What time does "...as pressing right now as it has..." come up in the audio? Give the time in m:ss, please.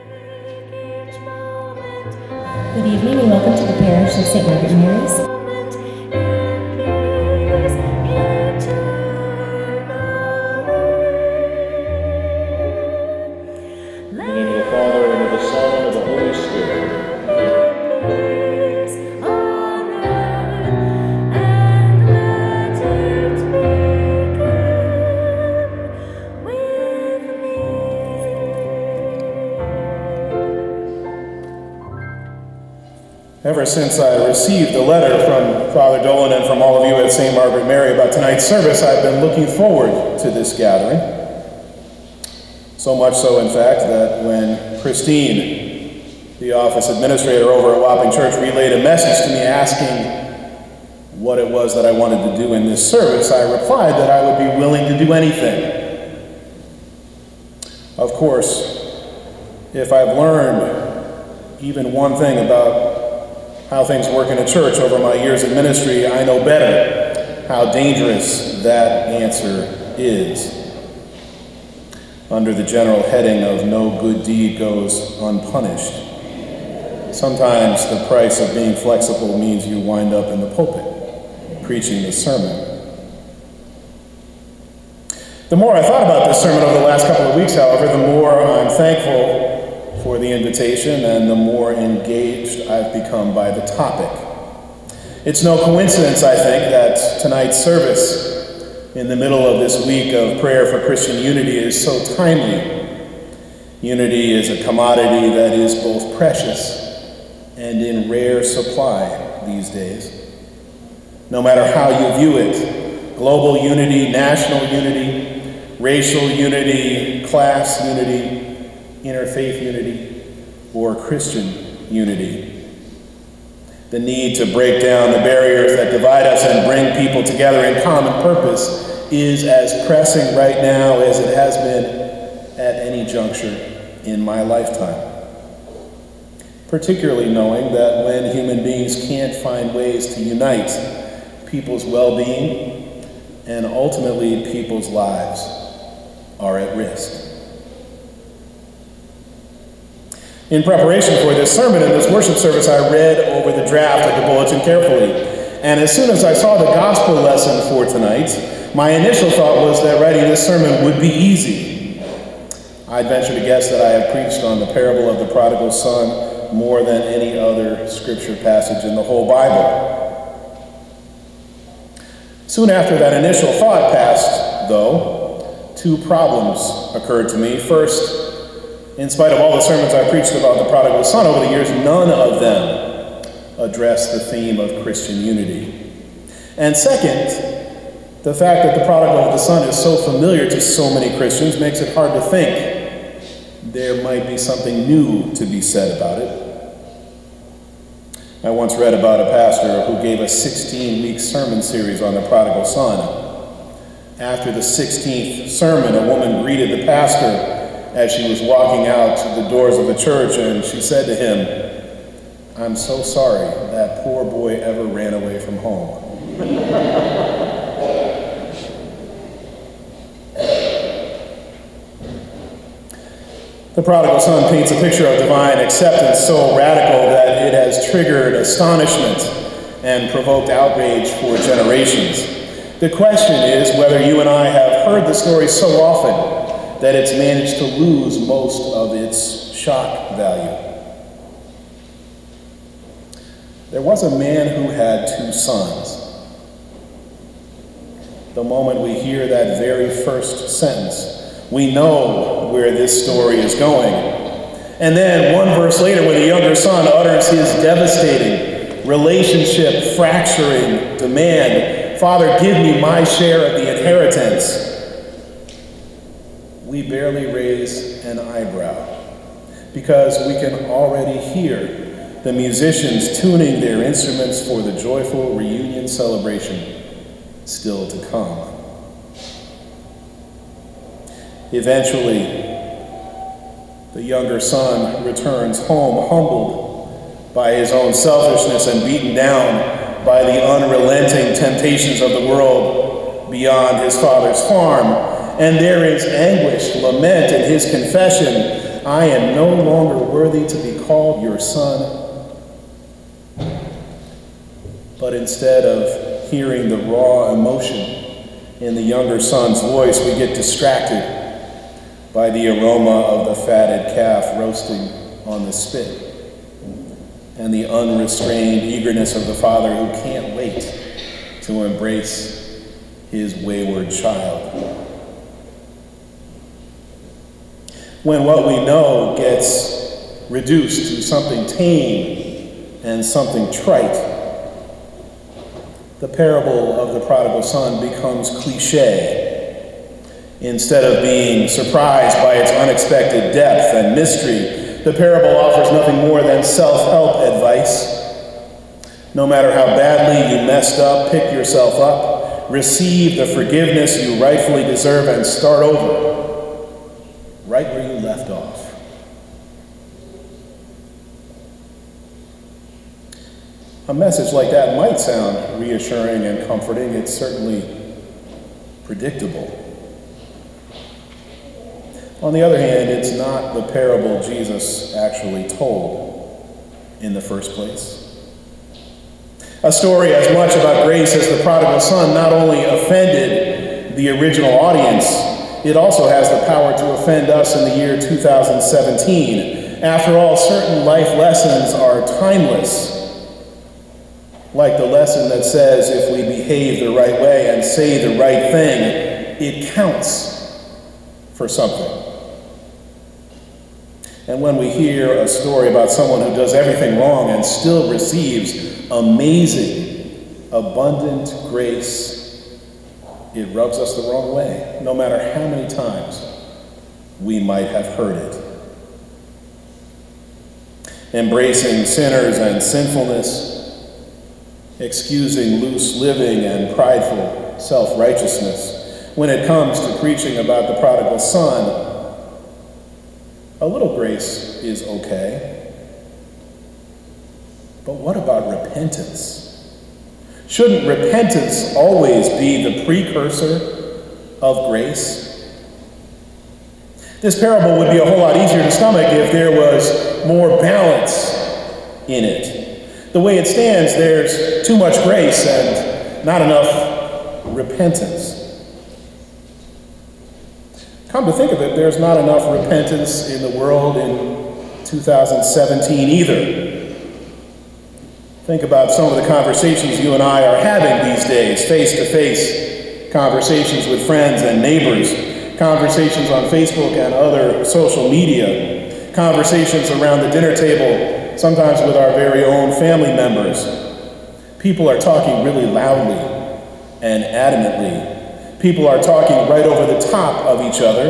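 2:09.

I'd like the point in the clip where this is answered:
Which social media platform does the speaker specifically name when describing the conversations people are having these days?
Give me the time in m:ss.
7:56.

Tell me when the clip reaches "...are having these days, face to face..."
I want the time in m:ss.
7:50.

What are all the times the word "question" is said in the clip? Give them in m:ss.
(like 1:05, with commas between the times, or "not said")
3:52.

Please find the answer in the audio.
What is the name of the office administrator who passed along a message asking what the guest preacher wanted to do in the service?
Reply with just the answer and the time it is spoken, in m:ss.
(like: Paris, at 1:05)
Christine, at 0:44.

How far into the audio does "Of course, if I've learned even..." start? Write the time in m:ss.
0:57.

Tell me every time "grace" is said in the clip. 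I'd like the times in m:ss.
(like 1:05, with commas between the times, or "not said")
6:20, 6:51, 7:13, 7:24, 7:35.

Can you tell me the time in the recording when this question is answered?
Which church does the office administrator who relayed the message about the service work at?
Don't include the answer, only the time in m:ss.
0:47.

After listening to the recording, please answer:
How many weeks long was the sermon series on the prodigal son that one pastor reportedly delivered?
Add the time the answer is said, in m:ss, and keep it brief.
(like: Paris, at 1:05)
16, at 3:20.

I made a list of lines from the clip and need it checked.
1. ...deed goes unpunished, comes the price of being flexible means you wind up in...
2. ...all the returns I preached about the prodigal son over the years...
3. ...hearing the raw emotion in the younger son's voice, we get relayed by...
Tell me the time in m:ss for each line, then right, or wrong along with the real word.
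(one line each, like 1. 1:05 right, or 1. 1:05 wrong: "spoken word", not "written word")
1. 1:14 wrong: "sometimes", not "comes"
2. 2:59 wrong: "sermons", not "returns"
3. 5:06 wrong: "distracted", not "relayed".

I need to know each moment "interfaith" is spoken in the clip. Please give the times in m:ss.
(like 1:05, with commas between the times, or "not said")
1:59.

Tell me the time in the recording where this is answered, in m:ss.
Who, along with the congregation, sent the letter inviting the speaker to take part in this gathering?
0:35.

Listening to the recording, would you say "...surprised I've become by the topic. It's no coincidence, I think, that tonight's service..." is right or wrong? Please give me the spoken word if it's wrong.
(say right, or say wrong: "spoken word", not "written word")
wrong: "engaged", not "surprised".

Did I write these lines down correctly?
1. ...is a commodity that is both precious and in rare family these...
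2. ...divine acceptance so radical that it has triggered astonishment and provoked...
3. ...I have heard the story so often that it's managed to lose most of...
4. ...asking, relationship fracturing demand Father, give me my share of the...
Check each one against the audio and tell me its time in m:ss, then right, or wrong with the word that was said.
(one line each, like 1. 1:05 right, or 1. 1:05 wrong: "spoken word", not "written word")
1. 1:44 wrong: "supply", not "family"
2. 3:45 right
3. 3:54 right
4. 4:17 wrong: "devastating", not "asking".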